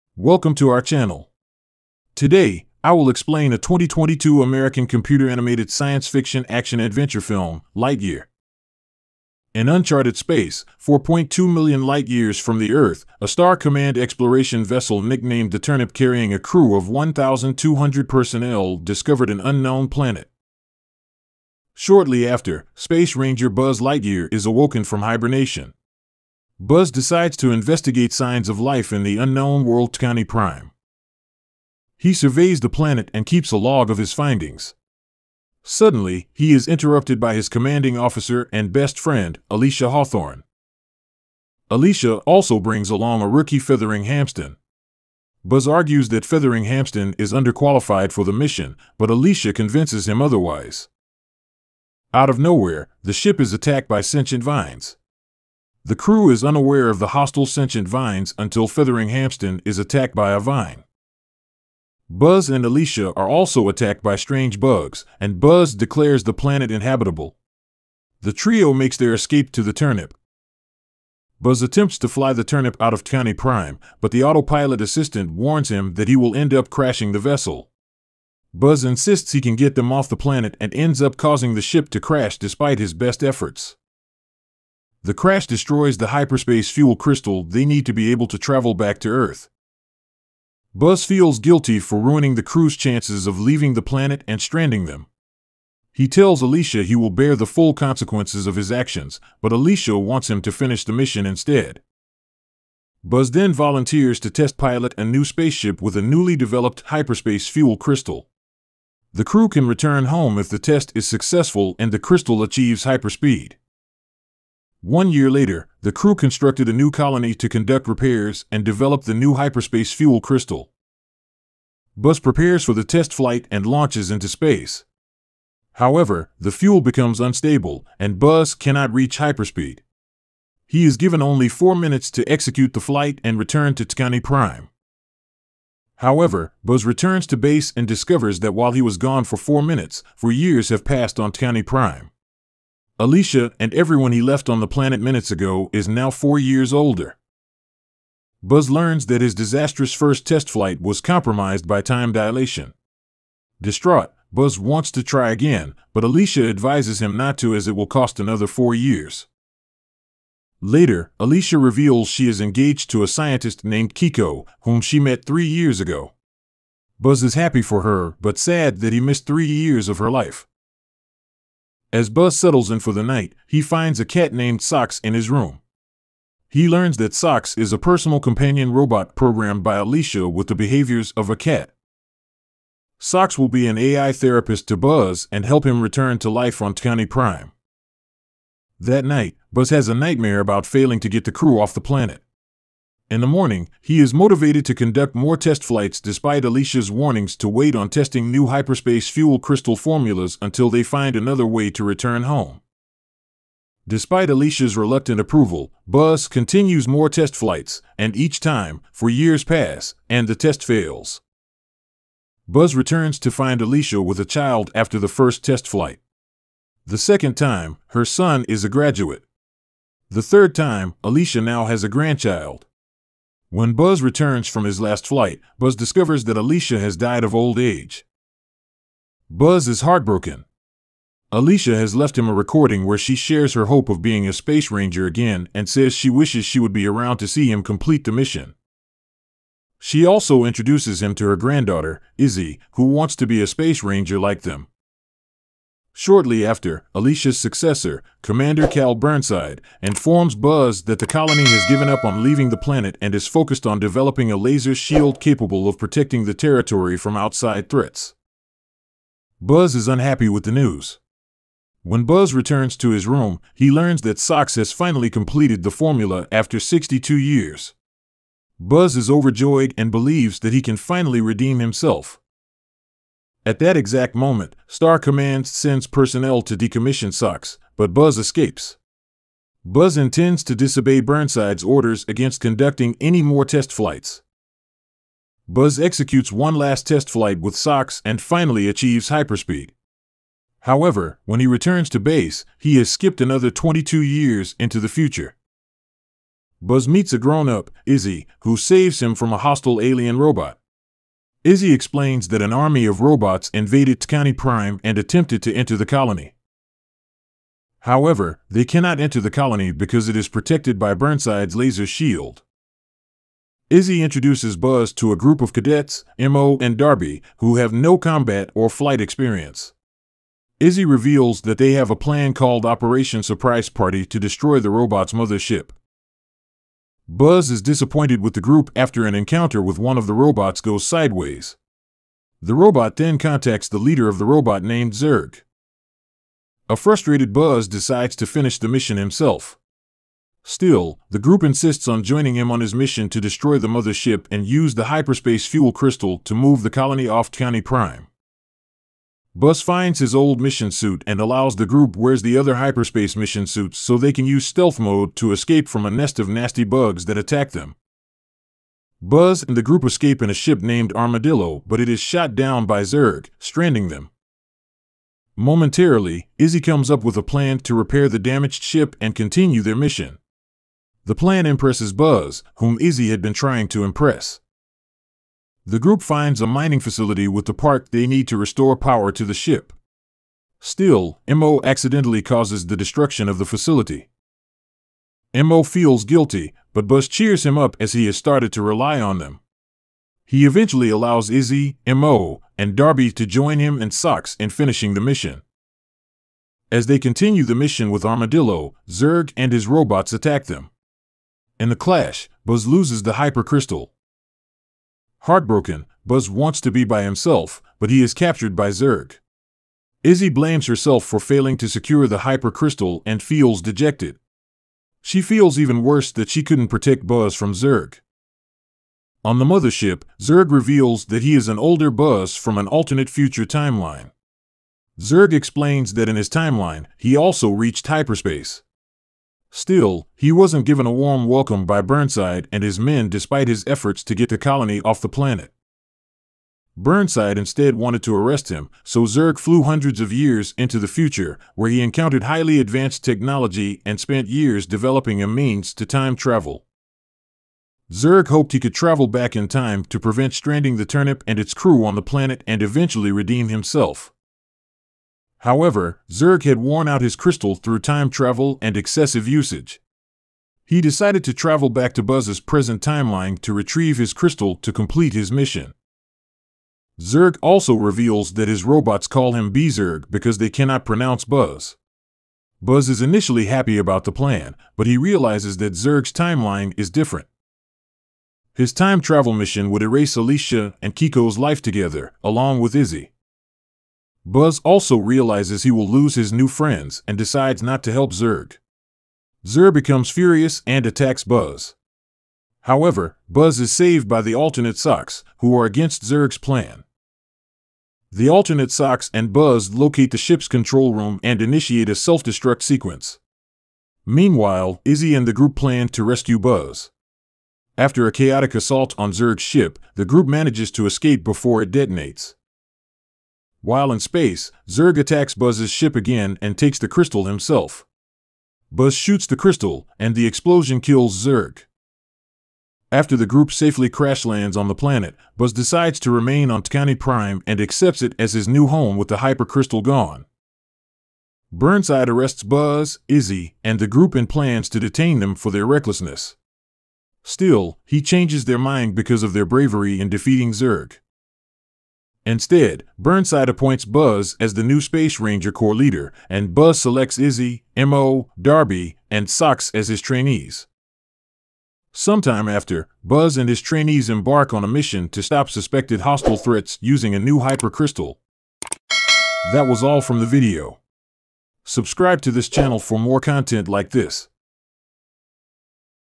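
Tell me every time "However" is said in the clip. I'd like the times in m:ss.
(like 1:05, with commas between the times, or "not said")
2:05, 2:15, 4:50, 5:07, 7:35, 8:12.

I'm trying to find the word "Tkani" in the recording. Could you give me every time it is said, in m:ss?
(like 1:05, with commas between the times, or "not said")
2:13, 2:21, 8:46.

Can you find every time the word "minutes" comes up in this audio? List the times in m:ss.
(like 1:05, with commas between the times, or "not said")
2:11, 2:19, 2:25.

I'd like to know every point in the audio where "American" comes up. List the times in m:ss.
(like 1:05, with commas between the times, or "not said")
0:04.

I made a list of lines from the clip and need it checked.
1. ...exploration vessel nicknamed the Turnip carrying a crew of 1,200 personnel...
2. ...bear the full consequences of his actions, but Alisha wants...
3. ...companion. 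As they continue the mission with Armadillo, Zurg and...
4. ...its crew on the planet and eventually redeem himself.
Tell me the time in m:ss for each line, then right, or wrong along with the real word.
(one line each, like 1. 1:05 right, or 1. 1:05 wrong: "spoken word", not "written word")
1. 0:13 right
2. 1:37 right
3. 6:35 wrong: "mission", not "companion"
4. 7:31 right.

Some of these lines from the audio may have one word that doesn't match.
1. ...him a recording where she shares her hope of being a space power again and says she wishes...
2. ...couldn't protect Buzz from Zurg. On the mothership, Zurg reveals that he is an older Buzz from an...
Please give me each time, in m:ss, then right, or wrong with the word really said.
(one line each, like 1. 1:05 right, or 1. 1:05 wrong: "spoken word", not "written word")
1. 3:52 wrong: "ranger", not "power"
2. 6:56 right.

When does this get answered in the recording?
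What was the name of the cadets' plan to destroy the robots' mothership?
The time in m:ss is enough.
5:22.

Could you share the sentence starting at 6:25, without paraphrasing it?
MO feels guilty, but Buzz cheers him up as he has started to rely on them.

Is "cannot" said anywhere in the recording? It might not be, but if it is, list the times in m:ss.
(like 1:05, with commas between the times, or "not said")
2:08, 5:08, 7:50.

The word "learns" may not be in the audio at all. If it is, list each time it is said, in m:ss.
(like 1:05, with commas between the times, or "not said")
2:28, 2:56, 4:23.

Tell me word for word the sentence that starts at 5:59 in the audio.
Buzz and the group escape in a ship named Armadillo, but it is shot down by Zurg, stranding them.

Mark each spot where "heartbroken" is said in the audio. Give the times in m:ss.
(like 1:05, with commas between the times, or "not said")
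3:49, 6:45.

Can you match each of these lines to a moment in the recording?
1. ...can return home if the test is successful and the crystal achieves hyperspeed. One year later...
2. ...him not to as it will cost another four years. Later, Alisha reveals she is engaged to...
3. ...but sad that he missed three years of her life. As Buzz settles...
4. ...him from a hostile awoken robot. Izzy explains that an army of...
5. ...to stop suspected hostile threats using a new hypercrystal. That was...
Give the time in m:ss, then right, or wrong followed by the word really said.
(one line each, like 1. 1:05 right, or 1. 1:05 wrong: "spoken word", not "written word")
1. 1:49 right
2. 2:37 right
3. 2:48 right
4. 4:59 wrong: "alien", not "awoken"
5. 9:15 right.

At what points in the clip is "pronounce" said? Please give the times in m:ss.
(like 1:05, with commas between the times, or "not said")
7:50.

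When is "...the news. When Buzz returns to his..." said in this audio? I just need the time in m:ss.
4:20.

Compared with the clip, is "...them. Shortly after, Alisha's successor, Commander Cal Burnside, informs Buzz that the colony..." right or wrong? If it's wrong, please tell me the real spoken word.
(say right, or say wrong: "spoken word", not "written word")
right.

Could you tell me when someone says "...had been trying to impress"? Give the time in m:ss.
6:13.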